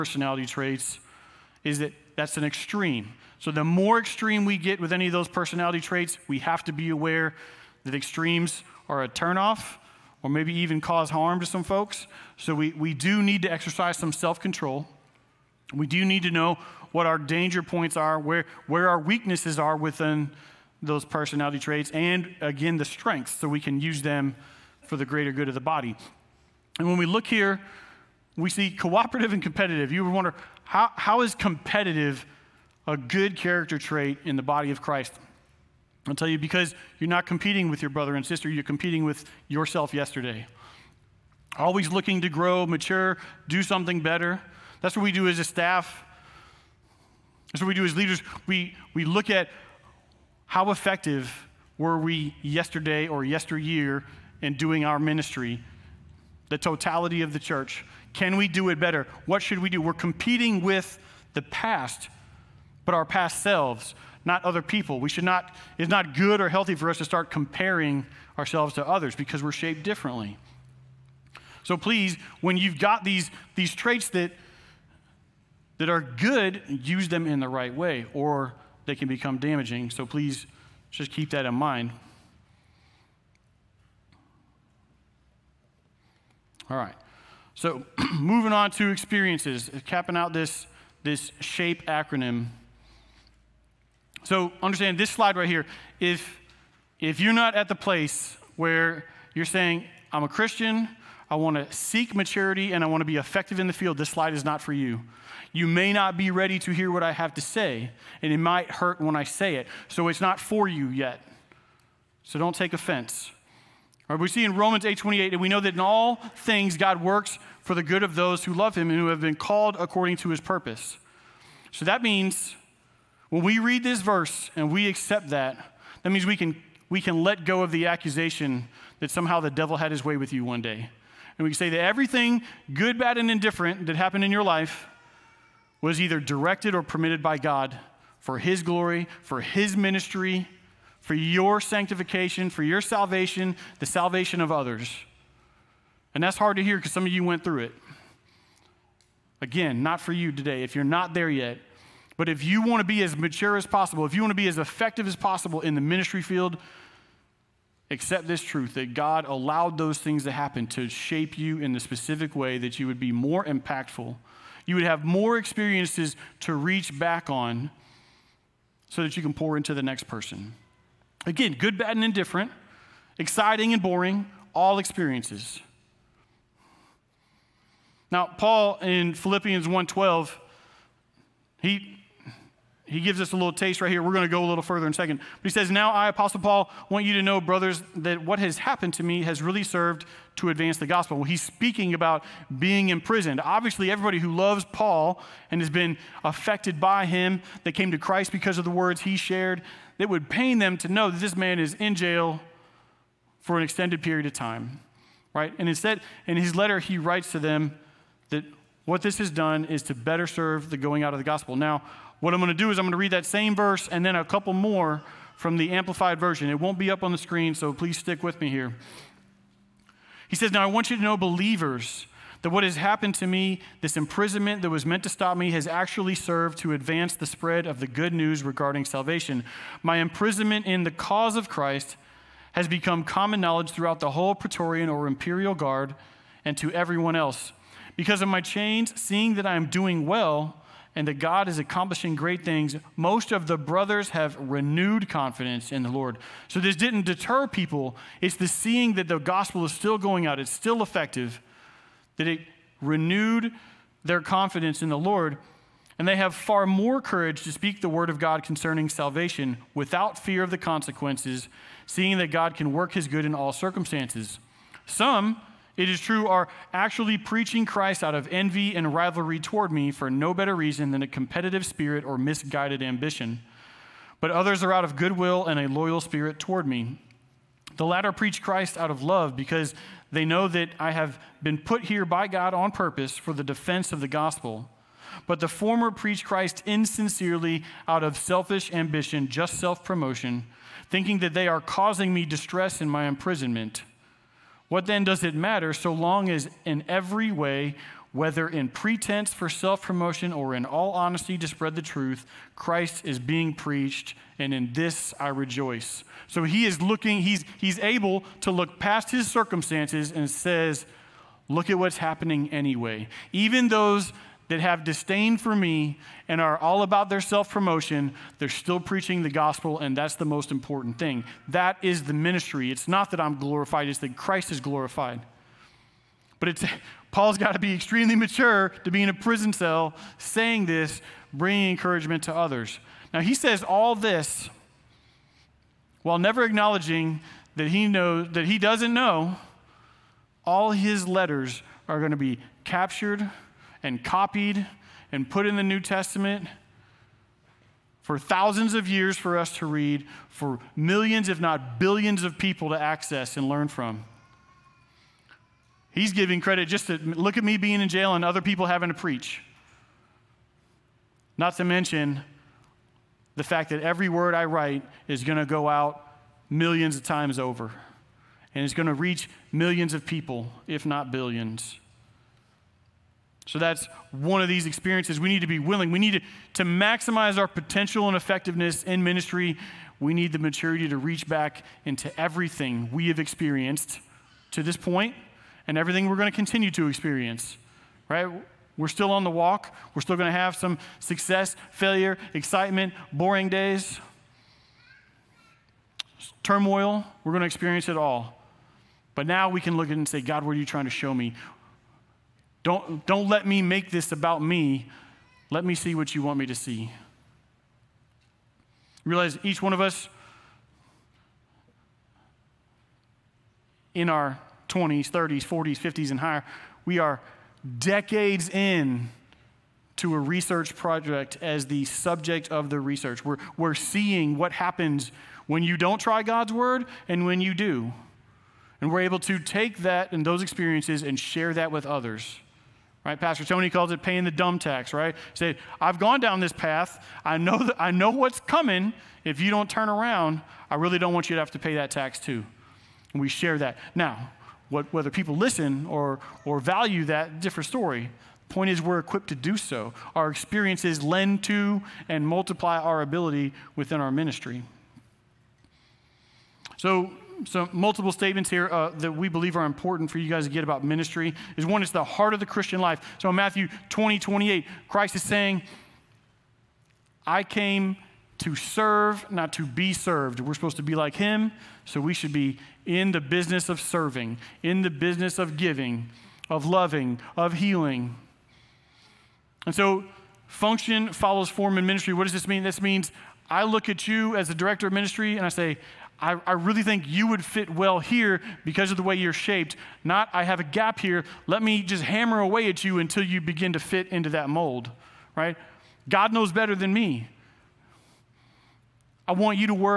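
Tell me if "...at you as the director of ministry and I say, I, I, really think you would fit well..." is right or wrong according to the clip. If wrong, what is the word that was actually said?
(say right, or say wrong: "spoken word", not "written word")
right.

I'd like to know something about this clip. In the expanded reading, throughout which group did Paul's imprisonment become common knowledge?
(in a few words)
Praetorian or Imperial Guard.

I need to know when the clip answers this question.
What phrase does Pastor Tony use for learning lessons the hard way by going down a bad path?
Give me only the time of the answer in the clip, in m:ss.
7:14.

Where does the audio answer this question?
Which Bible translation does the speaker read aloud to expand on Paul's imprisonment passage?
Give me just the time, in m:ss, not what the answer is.
3:35.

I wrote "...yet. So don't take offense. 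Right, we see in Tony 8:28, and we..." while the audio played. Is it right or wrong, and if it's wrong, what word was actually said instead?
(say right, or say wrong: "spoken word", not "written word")
wrong: "Romans", not "Tony".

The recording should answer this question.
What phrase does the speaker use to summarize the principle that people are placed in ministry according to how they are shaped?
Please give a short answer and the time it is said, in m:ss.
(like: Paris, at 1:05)
function follows form, at 8:00.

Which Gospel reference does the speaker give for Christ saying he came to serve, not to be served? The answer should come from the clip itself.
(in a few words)
Matthew 20:28.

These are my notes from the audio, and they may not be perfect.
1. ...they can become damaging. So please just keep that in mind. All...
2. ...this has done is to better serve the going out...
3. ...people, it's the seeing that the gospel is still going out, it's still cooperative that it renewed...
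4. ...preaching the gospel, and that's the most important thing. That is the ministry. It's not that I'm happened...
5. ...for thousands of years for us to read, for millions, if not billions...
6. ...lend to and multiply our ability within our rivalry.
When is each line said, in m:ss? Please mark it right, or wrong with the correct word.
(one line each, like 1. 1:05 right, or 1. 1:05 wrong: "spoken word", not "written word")
1. 1:18 right
2. 3:29 right
3. 4:07 wrong: "effective", not "cooperative"
4. 5:18 wrong: "glorified", not "happened"
5. 5:48 right
6. 7:31 wrong: "ministry", not "rivalry".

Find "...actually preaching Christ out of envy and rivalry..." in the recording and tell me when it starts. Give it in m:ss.
4:26.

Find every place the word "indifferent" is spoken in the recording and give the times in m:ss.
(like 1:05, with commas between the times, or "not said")
2:13, 2:52.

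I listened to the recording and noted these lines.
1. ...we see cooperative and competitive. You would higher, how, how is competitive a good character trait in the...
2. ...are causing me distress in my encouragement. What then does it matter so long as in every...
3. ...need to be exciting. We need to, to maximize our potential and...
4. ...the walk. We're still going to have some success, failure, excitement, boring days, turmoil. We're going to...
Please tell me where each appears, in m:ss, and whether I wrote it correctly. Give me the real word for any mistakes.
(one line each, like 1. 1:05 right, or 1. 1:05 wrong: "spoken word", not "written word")
1. 0:28 wrong: "wonder", not "higher"
2. 4:51 wrong: "imprisonment", not "encouragement"
3. 6:15 wrong: "willing", not "exciting"
4. 6:29 right.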